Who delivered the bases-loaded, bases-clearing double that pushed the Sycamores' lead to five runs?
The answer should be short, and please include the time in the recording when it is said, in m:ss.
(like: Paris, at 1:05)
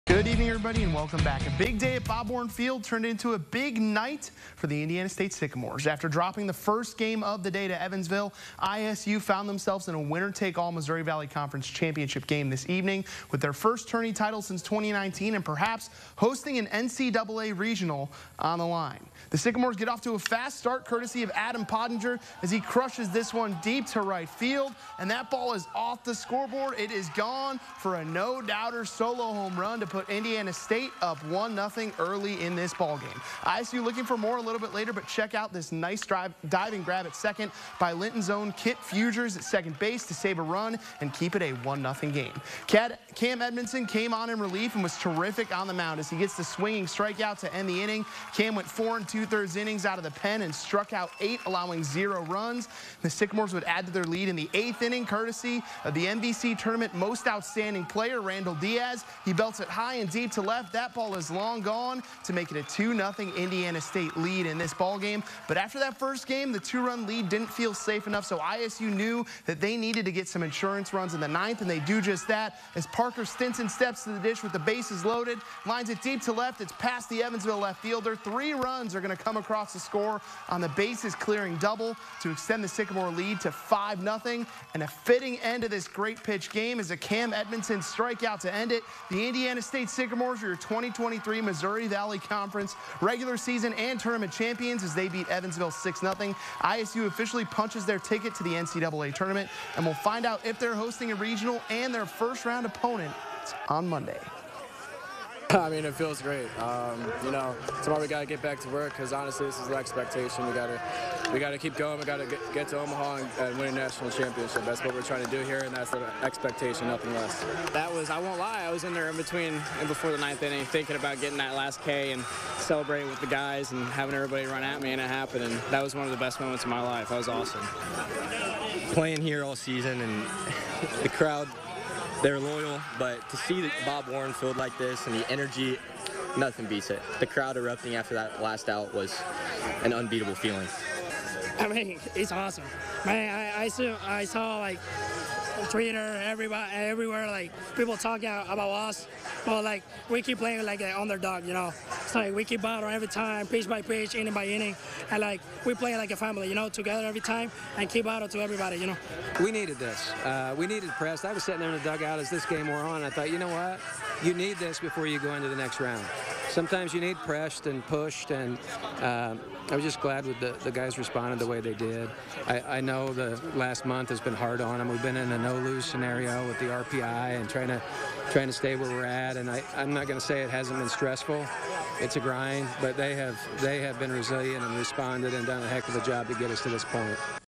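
Parker Stinson, at 1:12.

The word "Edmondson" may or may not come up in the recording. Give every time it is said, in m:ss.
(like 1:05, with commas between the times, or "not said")
0:43, 1:27.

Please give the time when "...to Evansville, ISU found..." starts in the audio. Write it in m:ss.
0:07.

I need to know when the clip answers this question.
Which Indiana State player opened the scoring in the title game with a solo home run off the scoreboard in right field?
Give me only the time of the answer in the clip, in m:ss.
0:21.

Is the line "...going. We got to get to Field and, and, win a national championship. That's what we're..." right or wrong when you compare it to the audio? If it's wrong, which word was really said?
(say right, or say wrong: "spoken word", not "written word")
wrong: "Omaha", not "Field".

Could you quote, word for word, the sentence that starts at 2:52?
I, I know the last month has been hard on them.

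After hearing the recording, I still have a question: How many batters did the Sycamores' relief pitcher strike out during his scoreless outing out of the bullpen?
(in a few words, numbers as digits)
8.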